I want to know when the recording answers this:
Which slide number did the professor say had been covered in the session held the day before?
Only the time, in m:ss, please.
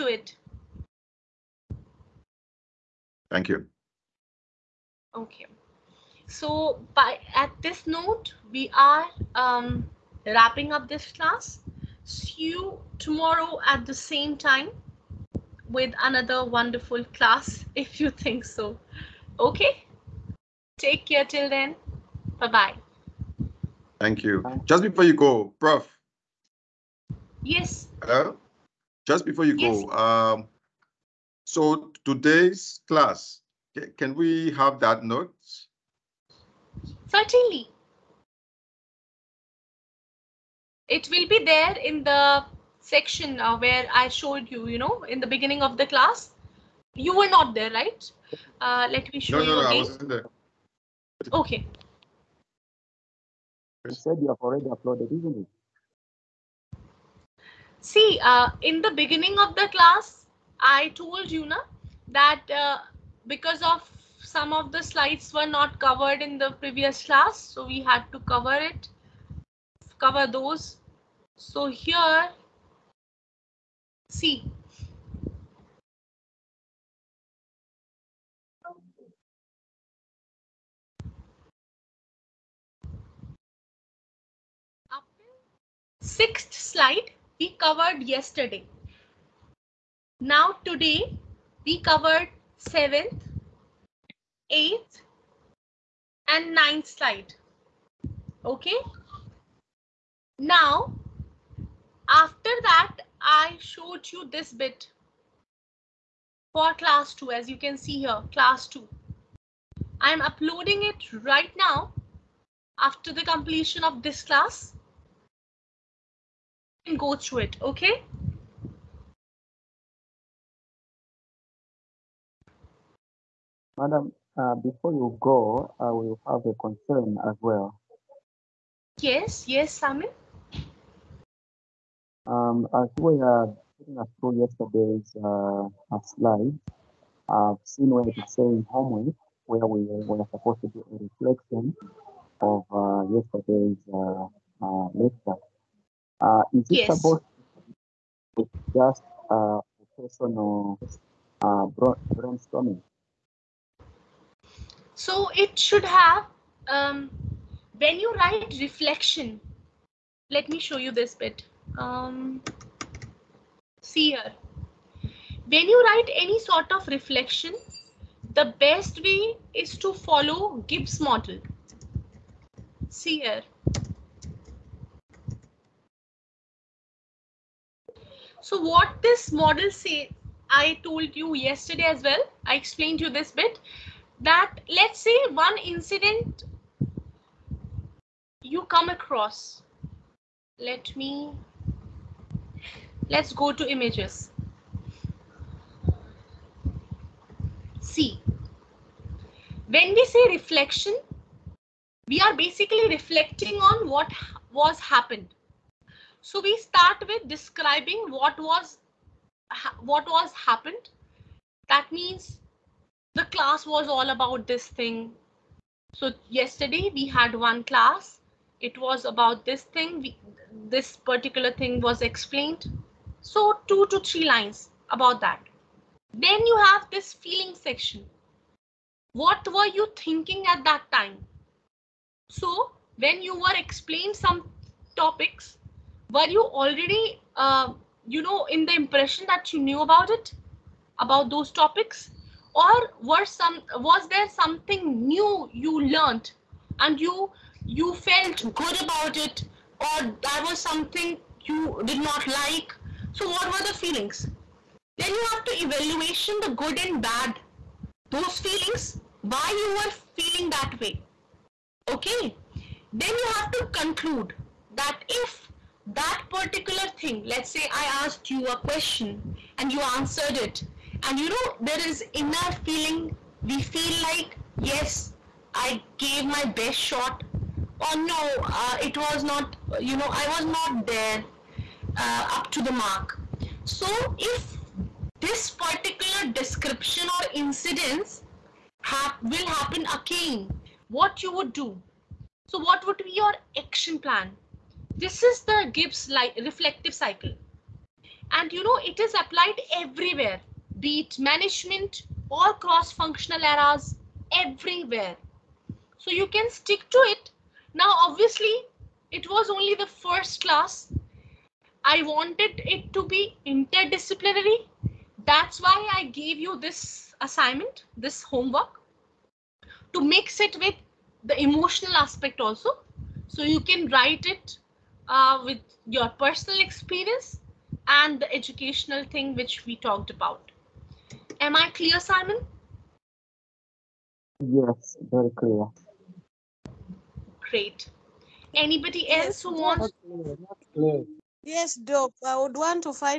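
1:26.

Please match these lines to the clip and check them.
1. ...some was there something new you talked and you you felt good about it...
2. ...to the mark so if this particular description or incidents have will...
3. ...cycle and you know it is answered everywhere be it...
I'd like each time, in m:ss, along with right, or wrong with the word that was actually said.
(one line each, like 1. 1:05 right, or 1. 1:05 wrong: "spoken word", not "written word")
1. 4:03 wrong: "learned", not "talked"
2. 4:42 right
3. 4:56 wrong: "applied", not "answered".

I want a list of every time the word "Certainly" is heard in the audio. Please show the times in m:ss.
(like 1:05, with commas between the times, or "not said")
0:37.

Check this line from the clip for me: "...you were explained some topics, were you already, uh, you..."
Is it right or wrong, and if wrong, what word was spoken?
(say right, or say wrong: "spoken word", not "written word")
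right.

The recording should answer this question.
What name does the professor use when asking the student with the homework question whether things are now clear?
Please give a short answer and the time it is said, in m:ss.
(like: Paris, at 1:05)
Simon, at 5:31.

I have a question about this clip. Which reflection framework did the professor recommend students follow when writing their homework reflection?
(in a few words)
Gibbs model.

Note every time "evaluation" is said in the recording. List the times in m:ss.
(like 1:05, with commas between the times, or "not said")
4:15.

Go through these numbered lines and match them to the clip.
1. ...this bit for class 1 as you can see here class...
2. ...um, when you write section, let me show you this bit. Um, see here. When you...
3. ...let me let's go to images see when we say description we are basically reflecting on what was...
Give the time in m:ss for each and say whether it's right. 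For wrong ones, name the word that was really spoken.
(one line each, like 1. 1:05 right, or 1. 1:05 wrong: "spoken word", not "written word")
1. 1:44 wrong: "2", not "1"
2. 2:36 wrong: "reflection", not "section"
3. 3:10 wrong: "reflection", not "description".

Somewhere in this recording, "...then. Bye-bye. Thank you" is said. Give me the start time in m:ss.
0:21.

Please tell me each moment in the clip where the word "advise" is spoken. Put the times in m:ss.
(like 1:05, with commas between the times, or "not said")
not said.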